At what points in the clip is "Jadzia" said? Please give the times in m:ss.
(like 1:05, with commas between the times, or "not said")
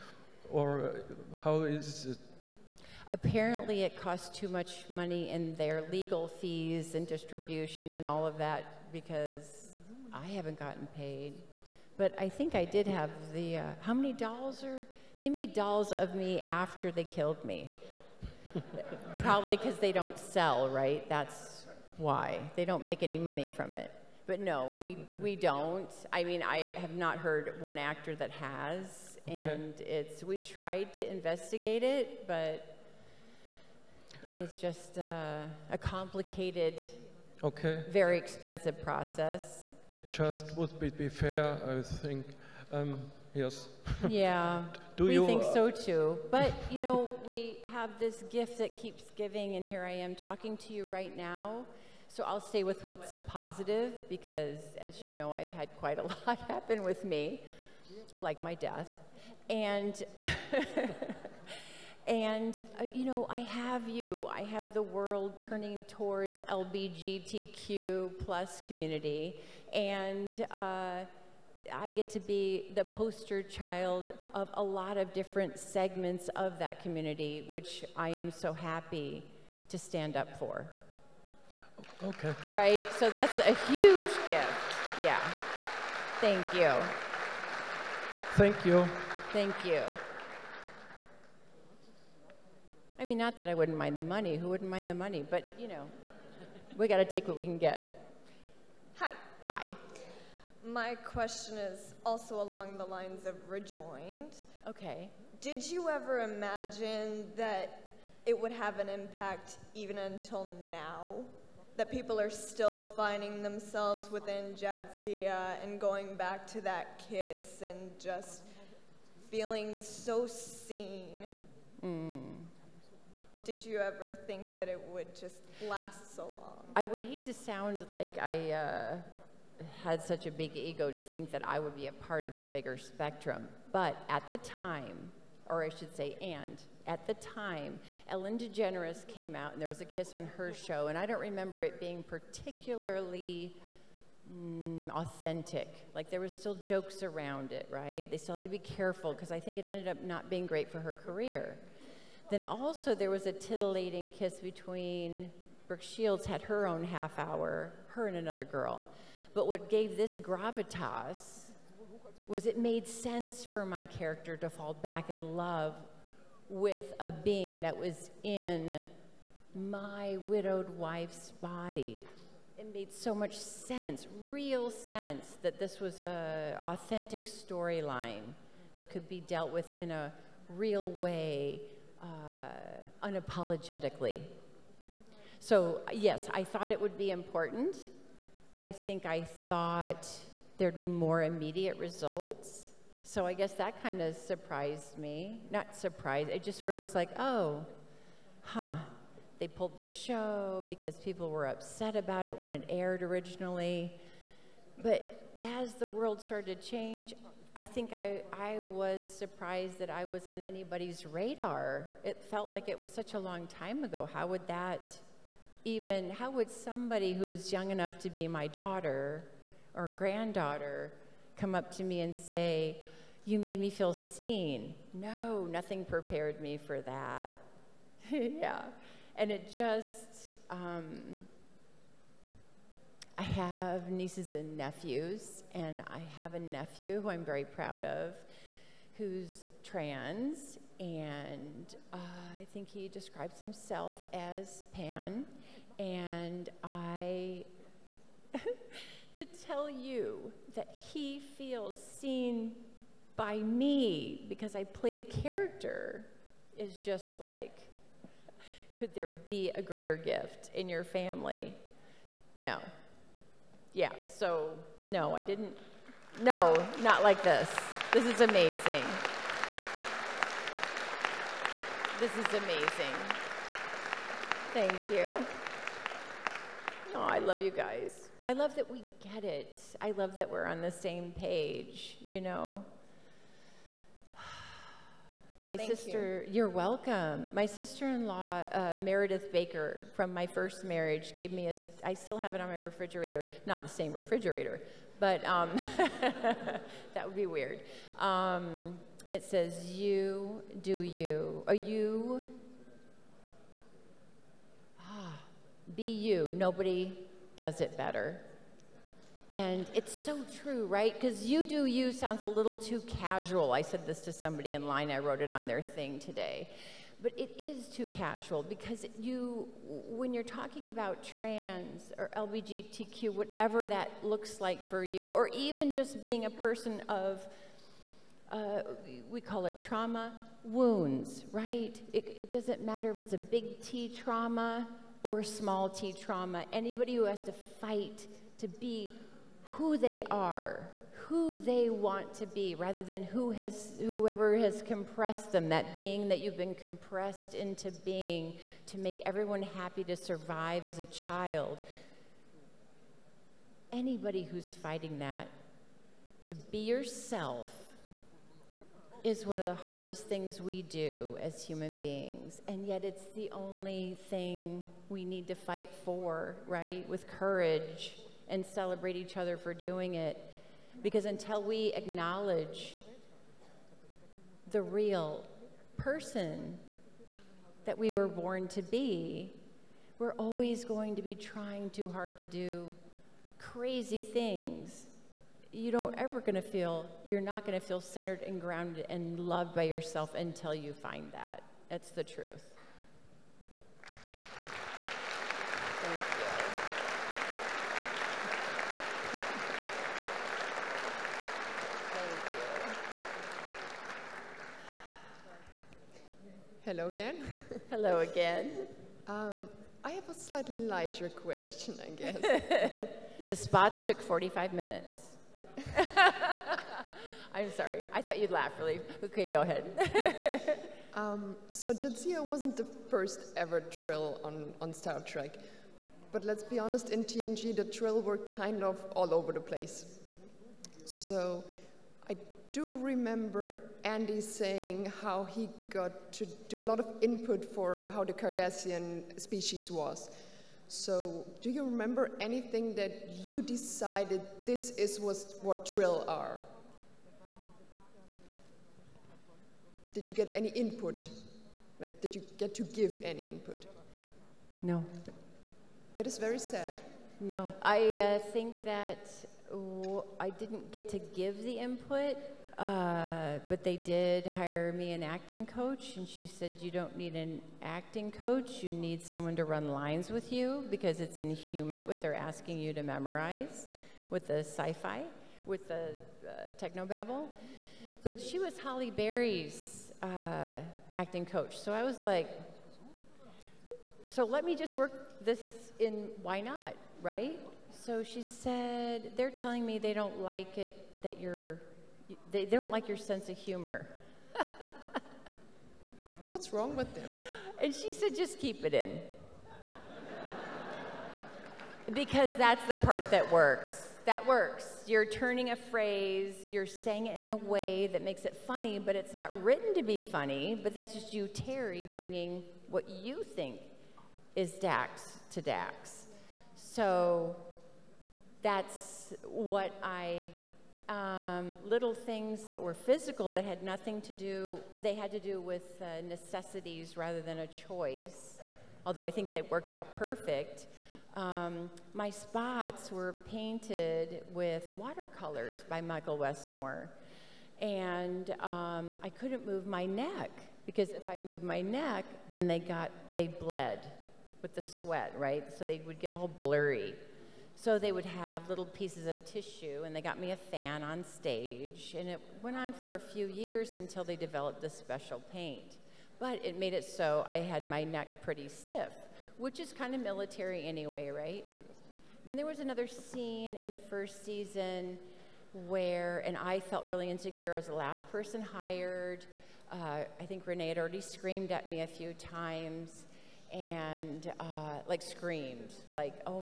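1:54, 7:01.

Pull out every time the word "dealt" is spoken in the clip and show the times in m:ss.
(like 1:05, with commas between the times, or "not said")
2:59.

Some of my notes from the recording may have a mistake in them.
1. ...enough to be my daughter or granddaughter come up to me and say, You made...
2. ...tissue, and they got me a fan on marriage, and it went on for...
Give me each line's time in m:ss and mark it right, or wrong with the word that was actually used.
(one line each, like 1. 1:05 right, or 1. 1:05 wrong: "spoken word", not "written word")
1. 3:37 right
2. 9:09 wrong: "stage", not "marriage".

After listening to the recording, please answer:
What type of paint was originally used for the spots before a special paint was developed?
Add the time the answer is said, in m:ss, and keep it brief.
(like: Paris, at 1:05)
watercolors, at 8:54.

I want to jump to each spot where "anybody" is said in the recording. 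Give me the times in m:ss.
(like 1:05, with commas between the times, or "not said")
3:30, 5:36, 5:53.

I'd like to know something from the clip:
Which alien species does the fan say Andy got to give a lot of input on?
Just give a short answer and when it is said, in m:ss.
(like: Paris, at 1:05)
Cardassian, at 7:18.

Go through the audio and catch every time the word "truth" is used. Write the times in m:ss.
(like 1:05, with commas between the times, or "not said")
6:32.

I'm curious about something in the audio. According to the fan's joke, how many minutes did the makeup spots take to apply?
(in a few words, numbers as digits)
45.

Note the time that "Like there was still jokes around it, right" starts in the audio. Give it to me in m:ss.
2:25.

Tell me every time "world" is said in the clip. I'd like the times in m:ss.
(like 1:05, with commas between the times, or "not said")
1:04, 3:25.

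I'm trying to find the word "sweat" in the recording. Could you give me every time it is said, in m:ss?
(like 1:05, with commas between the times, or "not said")
9:04.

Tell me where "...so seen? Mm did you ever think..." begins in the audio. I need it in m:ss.
1:59.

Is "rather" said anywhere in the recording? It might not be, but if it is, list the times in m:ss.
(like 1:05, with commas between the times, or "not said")
5:42, 8:46.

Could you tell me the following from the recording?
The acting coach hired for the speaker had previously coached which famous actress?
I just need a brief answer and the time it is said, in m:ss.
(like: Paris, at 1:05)
Halle Berry, at 7:58.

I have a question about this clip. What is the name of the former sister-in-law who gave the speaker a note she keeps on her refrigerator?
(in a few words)
Meredith Baker.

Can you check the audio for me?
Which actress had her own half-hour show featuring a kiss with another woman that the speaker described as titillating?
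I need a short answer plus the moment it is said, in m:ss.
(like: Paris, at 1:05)
Brooke Shields, at 2:35.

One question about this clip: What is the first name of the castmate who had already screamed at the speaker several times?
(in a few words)
Renee.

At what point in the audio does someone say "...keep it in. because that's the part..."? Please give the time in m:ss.
8:18.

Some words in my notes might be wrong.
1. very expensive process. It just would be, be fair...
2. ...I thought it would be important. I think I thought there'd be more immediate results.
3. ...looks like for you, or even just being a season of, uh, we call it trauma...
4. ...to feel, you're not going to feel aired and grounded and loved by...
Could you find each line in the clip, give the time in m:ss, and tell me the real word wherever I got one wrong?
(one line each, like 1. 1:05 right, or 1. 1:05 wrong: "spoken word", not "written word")
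1. 0:37 right
2. 3:06 right
3. 5:24 wrong: "person", not "season"
4. 6:26 wrong: "centered", not "aired".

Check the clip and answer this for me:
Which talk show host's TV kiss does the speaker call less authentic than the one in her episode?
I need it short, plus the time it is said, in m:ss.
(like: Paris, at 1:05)
Ellen DeGeneres, at 2:18.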